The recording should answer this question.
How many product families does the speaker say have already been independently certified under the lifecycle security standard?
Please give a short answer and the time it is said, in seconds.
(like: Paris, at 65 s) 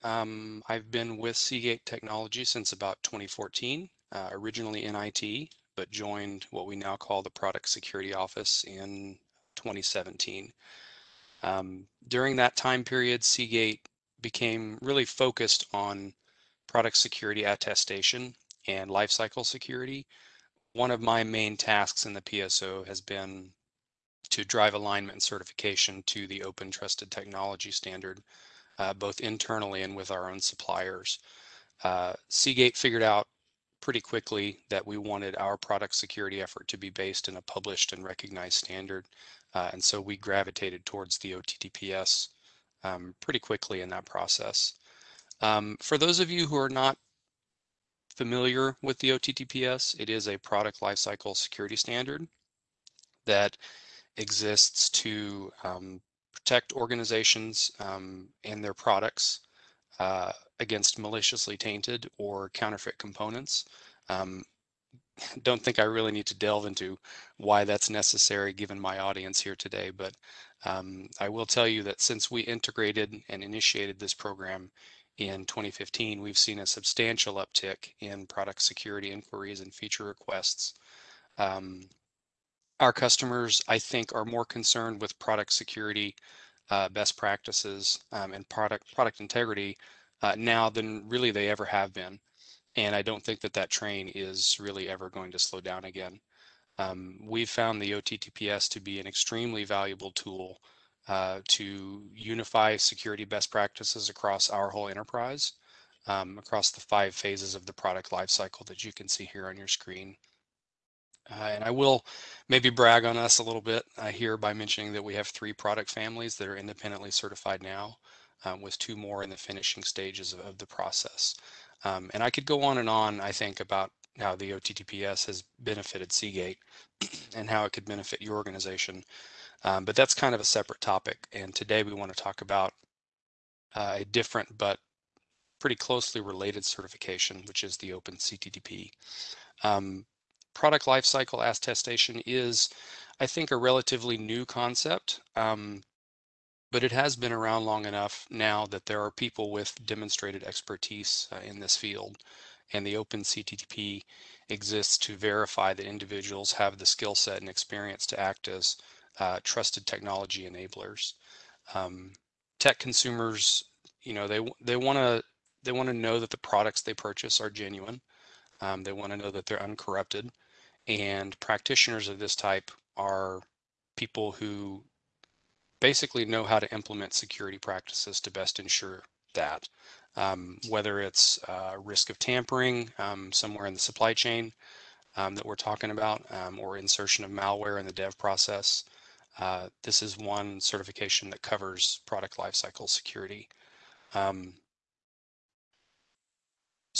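3, at 115 s.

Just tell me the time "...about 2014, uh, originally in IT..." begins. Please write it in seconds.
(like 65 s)
2 s.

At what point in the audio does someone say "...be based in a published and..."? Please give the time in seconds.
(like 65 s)
36 s.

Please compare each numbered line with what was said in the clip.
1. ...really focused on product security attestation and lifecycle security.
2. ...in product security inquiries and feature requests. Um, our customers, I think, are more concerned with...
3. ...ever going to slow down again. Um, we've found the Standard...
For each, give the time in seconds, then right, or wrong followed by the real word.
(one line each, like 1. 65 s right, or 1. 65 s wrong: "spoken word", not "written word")
1. 14 s right
2. 77 s right
3. 94 s wrong: "OTTPS", not "Standard".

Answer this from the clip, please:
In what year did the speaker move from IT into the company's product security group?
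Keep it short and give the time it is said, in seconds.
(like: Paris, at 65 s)
2017, at 9 s.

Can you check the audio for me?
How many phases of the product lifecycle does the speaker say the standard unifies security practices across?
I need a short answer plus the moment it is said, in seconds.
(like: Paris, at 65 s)
5, at 106 s.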